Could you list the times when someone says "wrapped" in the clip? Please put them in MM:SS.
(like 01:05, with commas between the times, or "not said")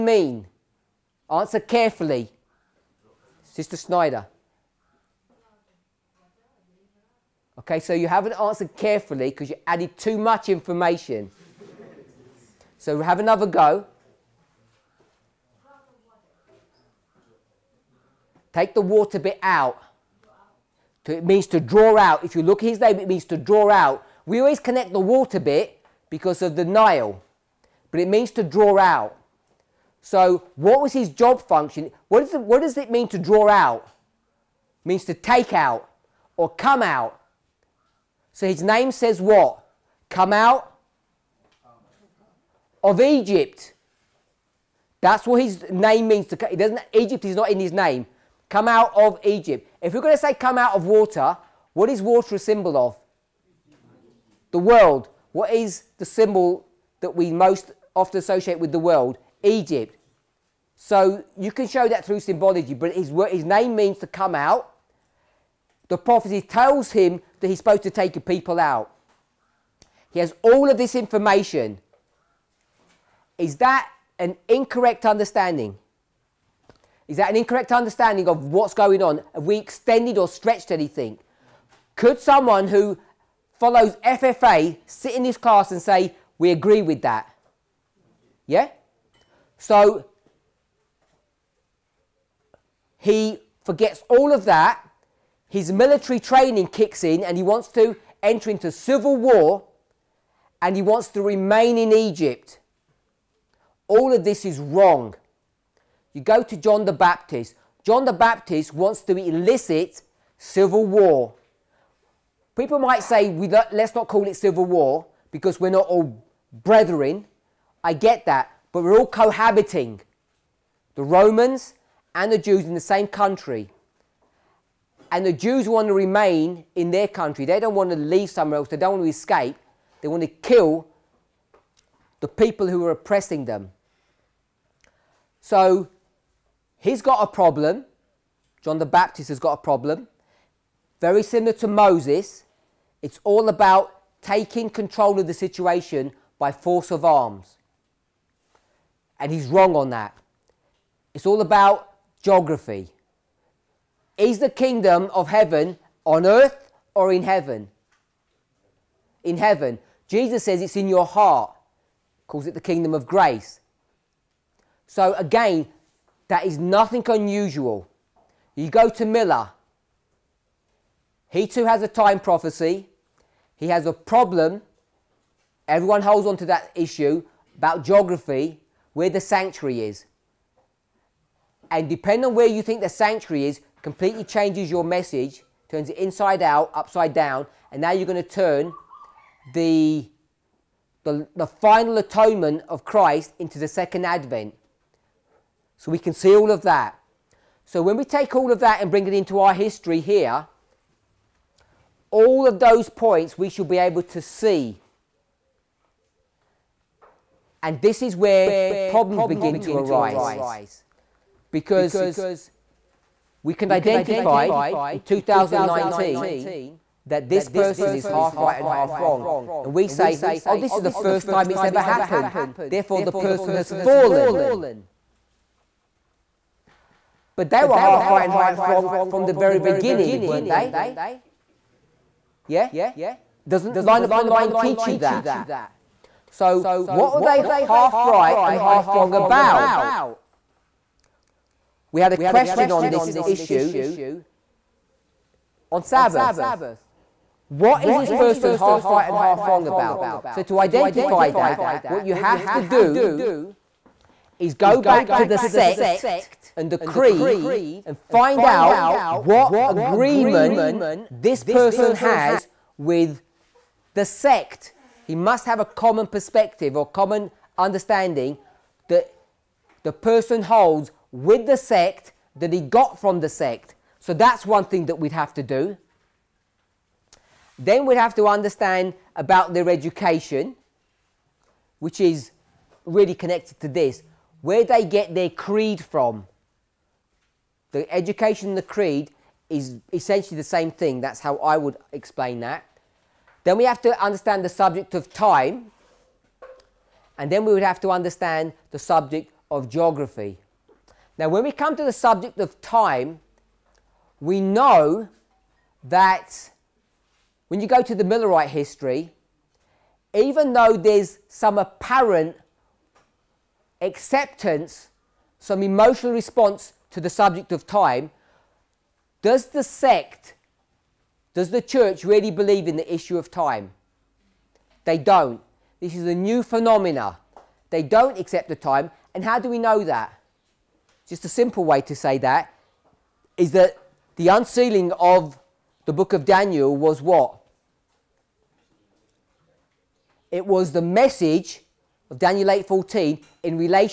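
not said.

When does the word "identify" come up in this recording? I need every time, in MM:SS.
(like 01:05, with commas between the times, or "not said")
03:33, 04:10.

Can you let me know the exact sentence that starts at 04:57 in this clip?
And then we would have to understand the subject of geography.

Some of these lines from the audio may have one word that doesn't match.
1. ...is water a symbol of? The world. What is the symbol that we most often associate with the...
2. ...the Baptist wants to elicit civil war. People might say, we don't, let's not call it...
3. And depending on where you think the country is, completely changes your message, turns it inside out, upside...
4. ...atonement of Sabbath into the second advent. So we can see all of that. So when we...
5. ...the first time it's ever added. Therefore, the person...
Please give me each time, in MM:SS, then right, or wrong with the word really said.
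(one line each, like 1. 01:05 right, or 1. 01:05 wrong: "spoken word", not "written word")
1. 00:51 right
2. 01:48 right
3. 03:01 wrong: "sanctuary", not "country"
4. 03:11 wrong: "Christ", not "Sabbath"
5. 03:40 wrong: "happened", not "added".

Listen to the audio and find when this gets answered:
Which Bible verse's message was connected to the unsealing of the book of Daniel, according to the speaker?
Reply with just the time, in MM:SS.
05:42.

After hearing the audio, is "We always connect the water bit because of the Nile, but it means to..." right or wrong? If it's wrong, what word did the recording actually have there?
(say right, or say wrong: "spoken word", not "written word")
right.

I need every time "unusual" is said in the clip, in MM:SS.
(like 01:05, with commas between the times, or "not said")
02:47.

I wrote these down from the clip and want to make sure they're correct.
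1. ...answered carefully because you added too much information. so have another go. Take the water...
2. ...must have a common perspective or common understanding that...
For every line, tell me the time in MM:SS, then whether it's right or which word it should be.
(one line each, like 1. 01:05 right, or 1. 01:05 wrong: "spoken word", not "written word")
1. 00:08 right
2. 04:25 right.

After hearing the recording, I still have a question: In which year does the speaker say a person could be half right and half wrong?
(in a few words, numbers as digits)
2019.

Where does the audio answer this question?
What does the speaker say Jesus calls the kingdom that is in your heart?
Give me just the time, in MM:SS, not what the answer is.
02:42.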